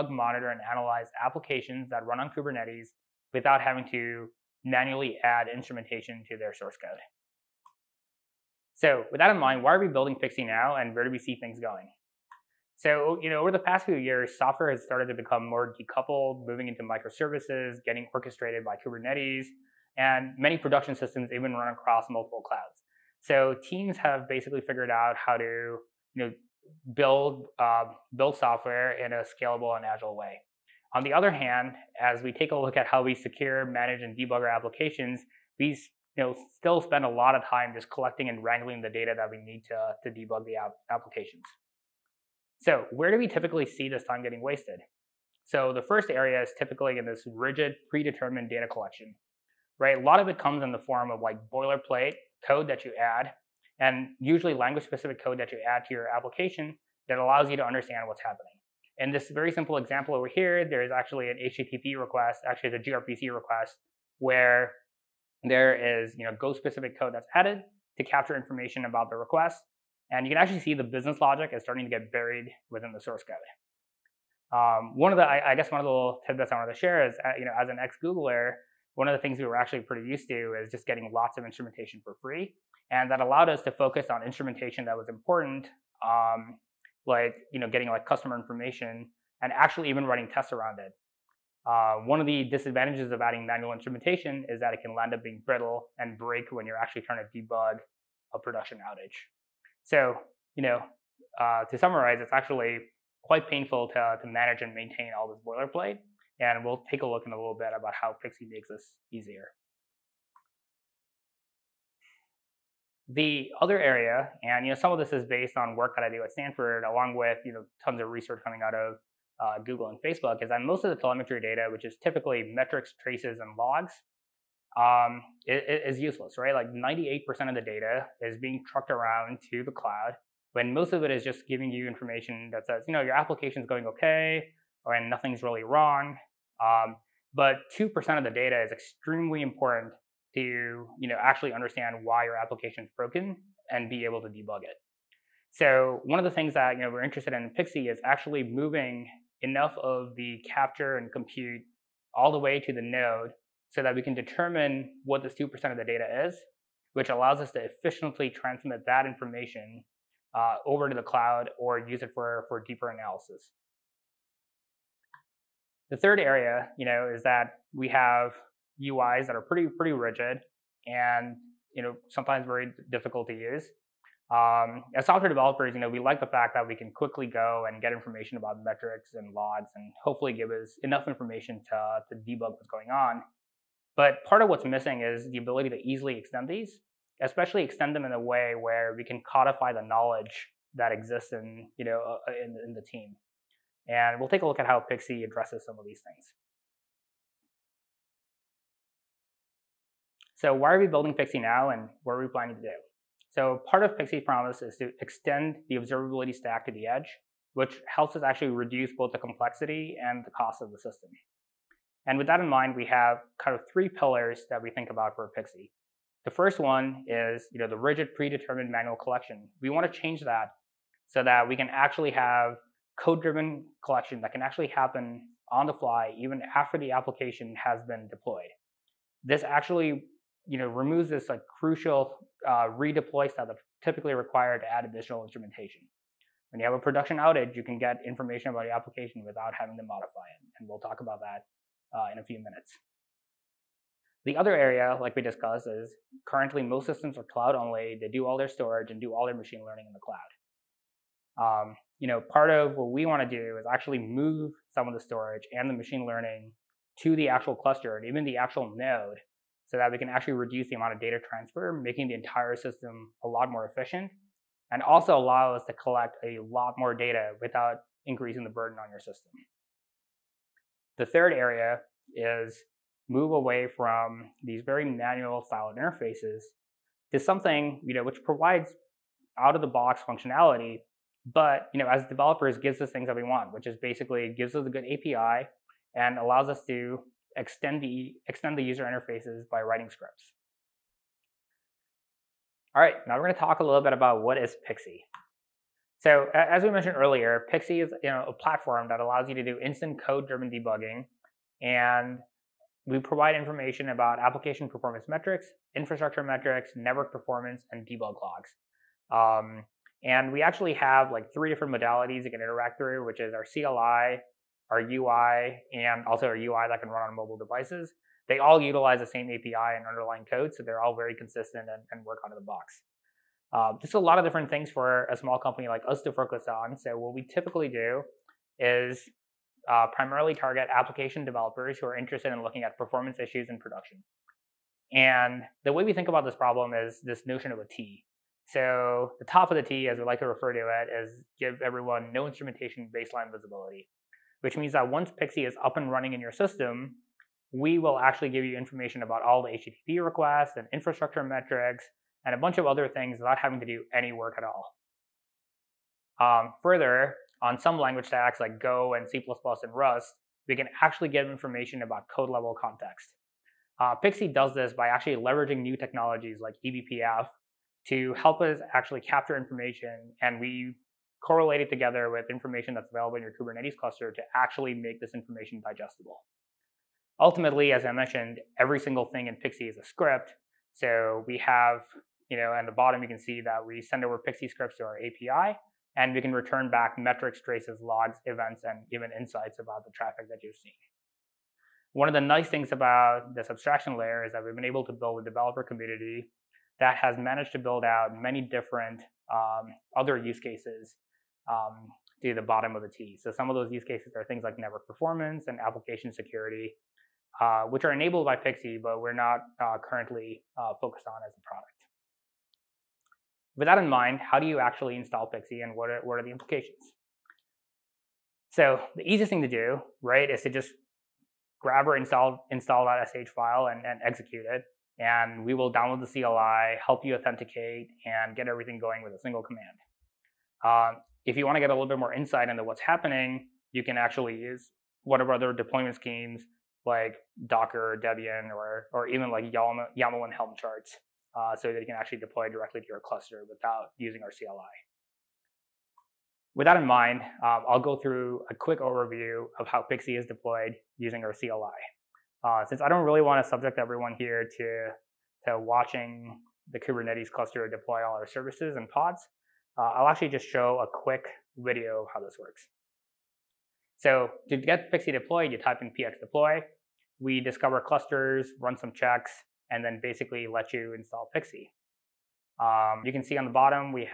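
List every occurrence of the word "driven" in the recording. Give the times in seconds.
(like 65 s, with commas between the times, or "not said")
222 s, 300 s.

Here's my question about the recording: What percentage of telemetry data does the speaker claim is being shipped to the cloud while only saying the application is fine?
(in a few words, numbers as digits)
98%.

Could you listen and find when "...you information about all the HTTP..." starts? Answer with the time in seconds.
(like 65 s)
348 s.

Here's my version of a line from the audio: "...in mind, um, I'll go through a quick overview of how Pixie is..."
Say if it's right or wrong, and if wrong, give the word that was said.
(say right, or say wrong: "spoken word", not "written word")
right.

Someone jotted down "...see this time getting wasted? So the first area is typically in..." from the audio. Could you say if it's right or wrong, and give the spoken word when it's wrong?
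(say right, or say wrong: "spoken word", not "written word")
right.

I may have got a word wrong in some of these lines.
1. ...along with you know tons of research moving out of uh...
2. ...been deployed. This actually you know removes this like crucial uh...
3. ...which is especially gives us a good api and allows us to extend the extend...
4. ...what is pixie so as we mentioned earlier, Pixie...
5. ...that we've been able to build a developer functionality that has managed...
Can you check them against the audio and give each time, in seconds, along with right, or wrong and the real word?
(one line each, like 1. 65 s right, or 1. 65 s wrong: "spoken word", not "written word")
1. 116 s wrong: "coming", not "moving"
2. 227 s right
3. 283 s wrong: "basically", not "especially"
4. 294 s right
5. 394 s wrong: "community", not "functionality".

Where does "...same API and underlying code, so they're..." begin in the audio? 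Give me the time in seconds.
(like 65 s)
319 s.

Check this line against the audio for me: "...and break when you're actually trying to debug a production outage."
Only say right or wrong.
right.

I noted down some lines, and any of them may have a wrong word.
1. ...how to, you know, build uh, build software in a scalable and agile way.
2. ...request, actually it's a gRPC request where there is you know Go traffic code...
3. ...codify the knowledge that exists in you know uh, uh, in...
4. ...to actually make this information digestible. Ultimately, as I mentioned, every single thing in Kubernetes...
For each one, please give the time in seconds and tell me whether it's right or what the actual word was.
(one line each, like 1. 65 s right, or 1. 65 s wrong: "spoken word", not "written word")
1. 25 s right
2. 61 s wrong: "specific", not "traffic"
3. 189 s right
4. 374 s wrong: "Pixie", not "Kubernetes".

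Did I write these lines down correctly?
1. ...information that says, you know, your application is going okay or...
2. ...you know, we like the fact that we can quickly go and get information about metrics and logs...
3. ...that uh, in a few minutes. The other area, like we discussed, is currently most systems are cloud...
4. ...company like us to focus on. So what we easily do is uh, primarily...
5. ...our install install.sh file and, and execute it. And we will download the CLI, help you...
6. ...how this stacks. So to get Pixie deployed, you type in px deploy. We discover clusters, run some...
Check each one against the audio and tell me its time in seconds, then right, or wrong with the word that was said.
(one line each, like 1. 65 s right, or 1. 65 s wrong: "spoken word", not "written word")
1. 131 s right
2. 175 s right
3. 241 s right
4. 325 s wrong: "typically", not "easily"
5. 421 s right
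6. 462 s wrong: "works", not "stacks".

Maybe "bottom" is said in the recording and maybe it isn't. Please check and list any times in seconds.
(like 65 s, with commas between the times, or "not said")
382 s, 402 s, 473 s.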